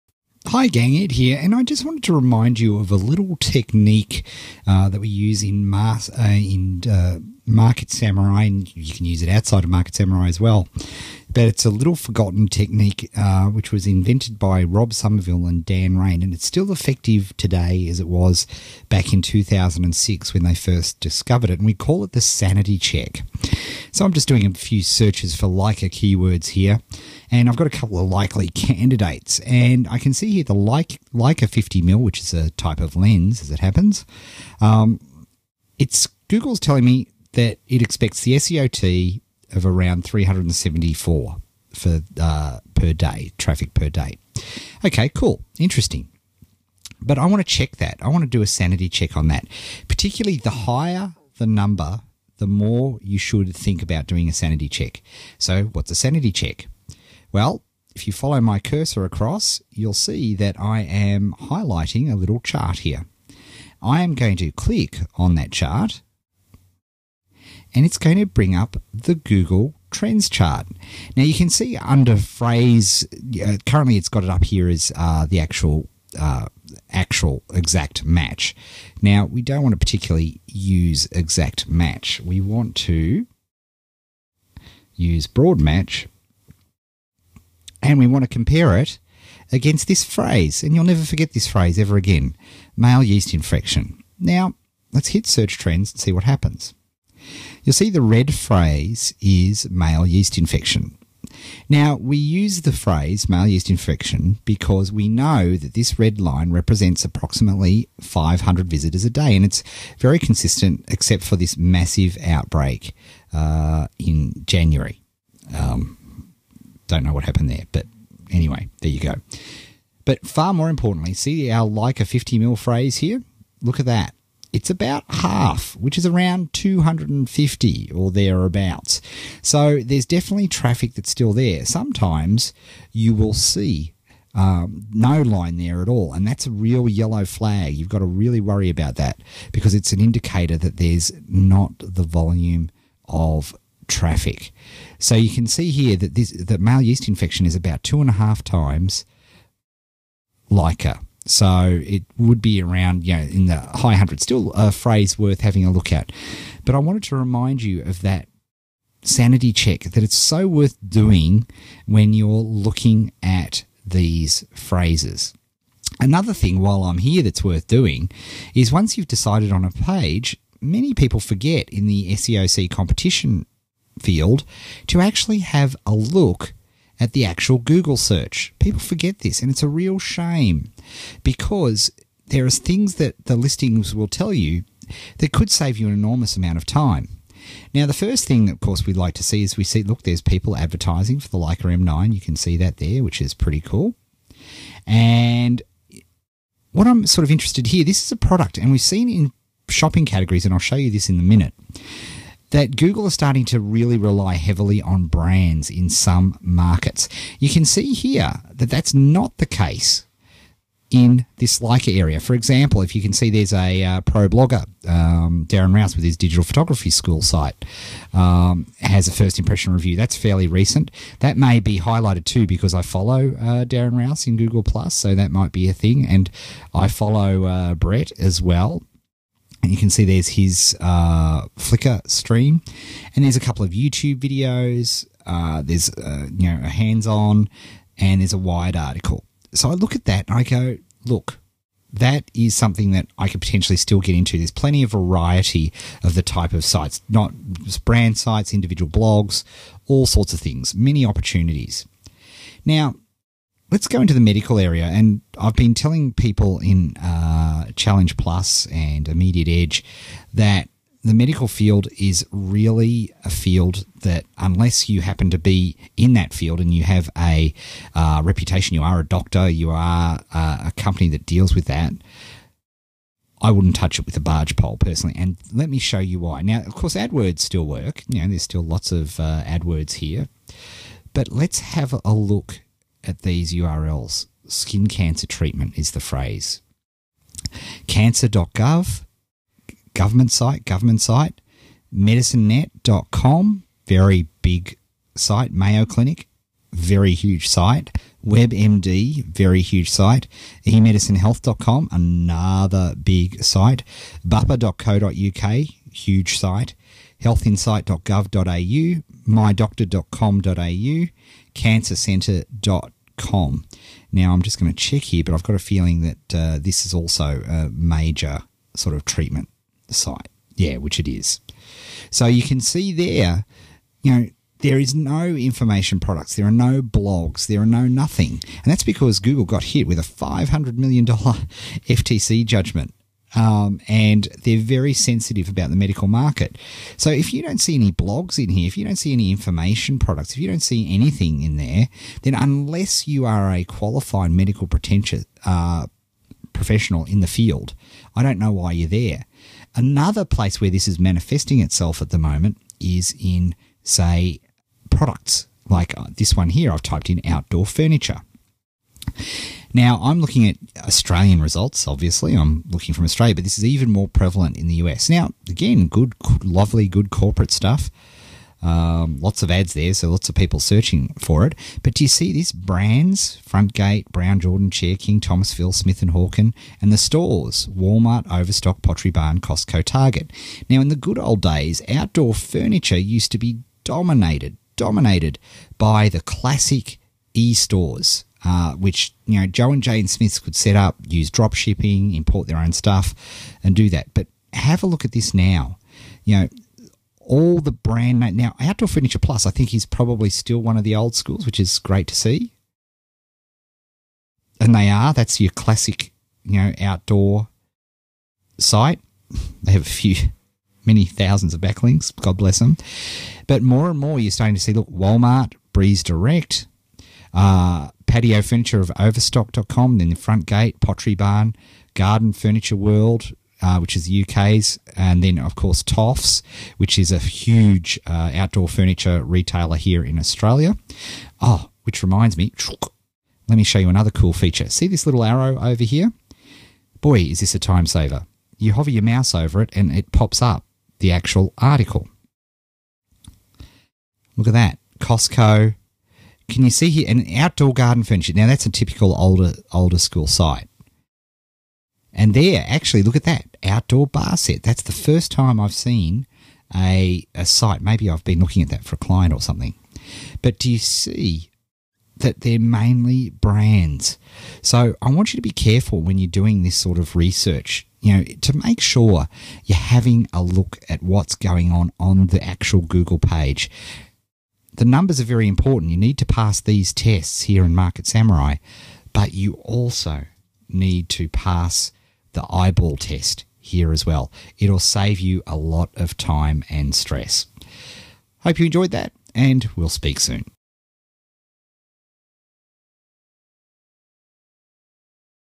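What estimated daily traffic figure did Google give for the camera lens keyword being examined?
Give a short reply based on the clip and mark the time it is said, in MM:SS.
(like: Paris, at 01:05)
374, at 00:40.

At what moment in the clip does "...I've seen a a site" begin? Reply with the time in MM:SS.
07:35.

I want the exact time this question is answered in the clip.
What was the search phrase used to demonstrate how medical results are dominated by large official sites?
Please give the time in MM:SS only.
04:44.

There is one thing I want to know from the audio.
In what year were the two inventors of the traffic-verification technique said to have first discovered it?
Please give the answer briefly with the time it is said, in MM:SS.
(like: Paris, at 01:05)
2006, at 00:19.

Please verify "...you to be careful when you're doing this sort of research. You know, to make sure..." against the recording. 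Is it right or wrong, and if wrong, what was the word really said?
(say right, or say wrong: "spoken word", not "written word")
right.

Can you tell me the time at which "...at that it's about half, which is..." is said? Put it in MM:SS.
02:03.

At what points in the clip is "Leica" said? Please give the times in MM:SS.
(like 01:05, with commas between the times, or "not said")
00:25, 00:30, 02:01, 02:30, 03:11.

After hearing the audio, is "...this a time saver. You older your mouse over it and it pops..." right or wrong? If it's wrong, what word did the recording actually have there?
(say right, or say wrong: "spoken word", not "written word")
wrong: "hover", not "older".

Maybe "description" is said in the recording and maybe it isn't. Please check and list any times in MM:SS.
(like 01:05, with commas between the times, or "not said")
not said.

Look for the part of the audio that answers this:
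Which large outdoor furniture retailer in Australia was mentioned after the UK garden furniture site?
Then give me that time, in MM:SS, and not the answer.
07:05.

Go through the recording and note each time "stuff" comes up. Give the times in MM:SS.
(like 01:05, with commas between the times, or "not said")
06:07, 06:32.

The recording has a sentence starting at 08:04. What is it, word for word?
It'll save you a lot of time and stress.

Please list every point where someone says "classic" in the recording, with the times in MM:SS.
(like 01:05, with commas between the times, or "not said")
06:26, 06:45.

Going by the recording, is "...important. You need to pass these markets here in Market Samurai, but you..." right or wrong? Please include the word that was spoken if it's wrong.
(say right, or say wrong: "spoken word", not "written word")
wrong: "tests", not "markets".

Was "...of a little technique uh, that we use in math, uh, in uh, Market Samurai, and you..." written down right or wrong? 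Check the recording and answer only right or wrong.
right.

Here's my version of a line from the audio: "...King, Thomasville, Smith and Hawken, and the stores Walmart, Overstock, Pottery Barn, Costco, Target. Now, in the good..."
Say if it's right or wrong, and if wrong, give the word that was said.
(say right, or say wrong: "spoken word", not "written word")
right.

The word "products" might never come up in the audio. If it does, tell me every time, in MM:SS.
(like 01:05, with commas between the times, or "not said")
03:18, 05:25, 05:39, 05:54.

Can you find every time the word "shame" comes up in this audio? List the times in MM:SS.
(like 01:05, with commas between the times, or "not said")
02:59.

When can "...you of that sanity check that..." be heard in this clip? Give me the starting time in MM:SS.
02:37.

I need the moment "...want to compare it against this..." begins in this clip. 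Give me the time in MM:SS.
01:28.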